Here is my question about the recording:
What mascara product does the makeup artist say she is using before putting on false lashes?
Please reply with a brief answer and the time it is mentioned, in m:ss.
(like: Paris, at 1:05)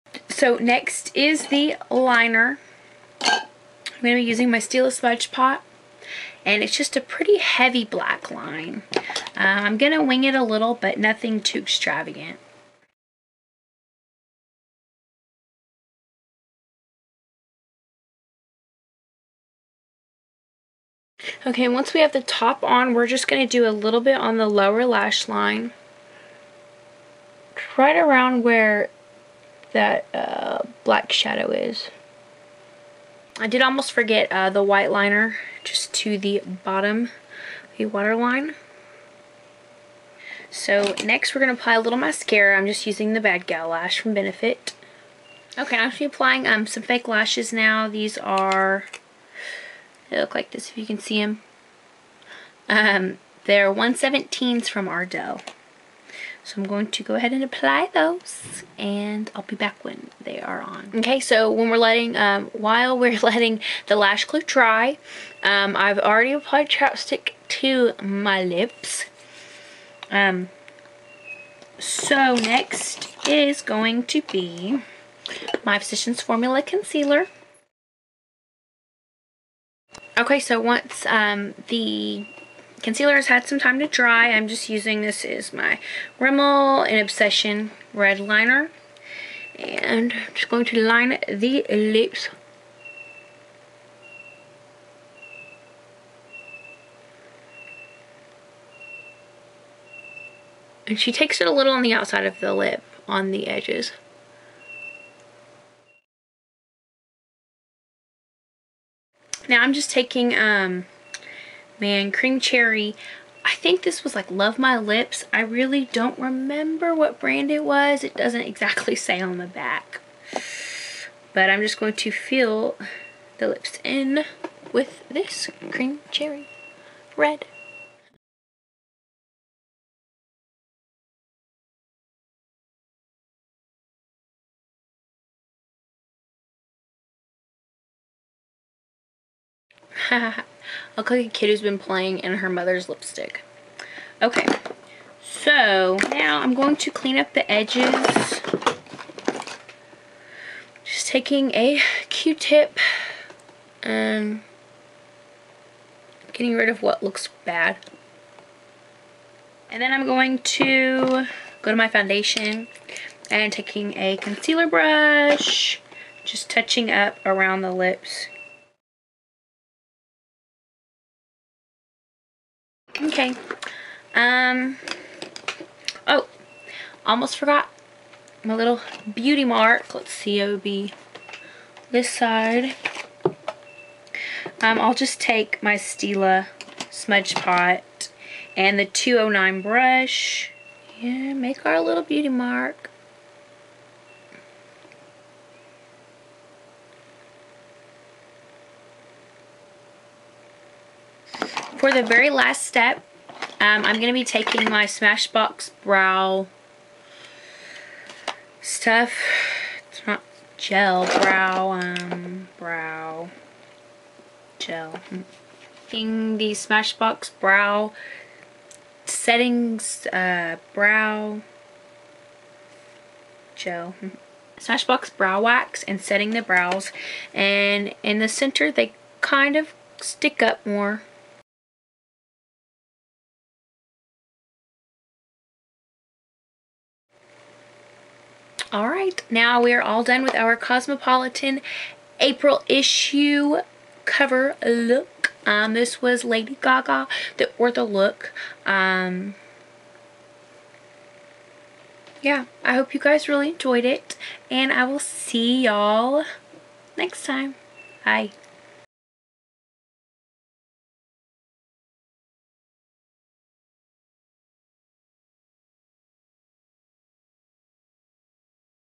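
Bad Gal Lash, at 0:43.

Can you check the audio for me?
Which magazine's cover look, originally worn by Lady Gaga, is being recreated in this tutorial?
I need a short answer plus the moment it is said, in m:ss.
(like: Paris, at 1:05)
Cosmopolitan, at 4:00.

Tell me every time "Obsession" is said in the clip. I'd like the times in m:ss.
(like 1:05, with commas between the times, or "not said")
1:26.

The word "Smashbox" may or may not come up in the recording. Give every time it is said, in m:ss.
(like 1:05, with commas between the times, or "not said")
3:24, 3:36, 3:44.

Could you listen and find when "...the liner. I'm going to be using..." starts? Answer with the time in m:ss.
0:01.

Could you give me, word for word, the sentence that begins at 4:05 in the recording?
Um, this was Lady Gaga, the look.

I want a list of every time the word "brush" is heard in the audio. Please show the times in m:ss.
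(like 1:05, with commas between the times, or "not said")
2:44, 3:09.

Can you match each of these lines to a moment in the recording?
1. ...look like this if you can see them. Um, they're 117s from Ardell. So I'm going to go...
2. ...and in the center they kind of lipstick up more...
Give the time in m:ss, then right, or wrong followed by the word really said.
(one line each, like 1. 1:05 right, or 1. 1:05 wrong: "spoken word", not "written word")
1. 0:50 right
2. 3:47 wrong: "stick", not "lipstick".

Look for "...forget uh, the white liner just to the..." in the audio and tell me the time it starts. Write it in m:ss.
0:33.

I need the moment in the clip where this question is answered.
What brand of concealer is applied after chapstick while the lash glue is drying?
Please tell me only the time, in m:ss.
1:15.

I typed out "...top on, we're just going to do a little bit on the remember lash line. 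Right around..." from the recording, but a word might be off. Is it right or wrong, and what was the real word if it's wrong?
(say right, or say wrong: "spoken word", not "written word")
wrong: "lower", not "remember".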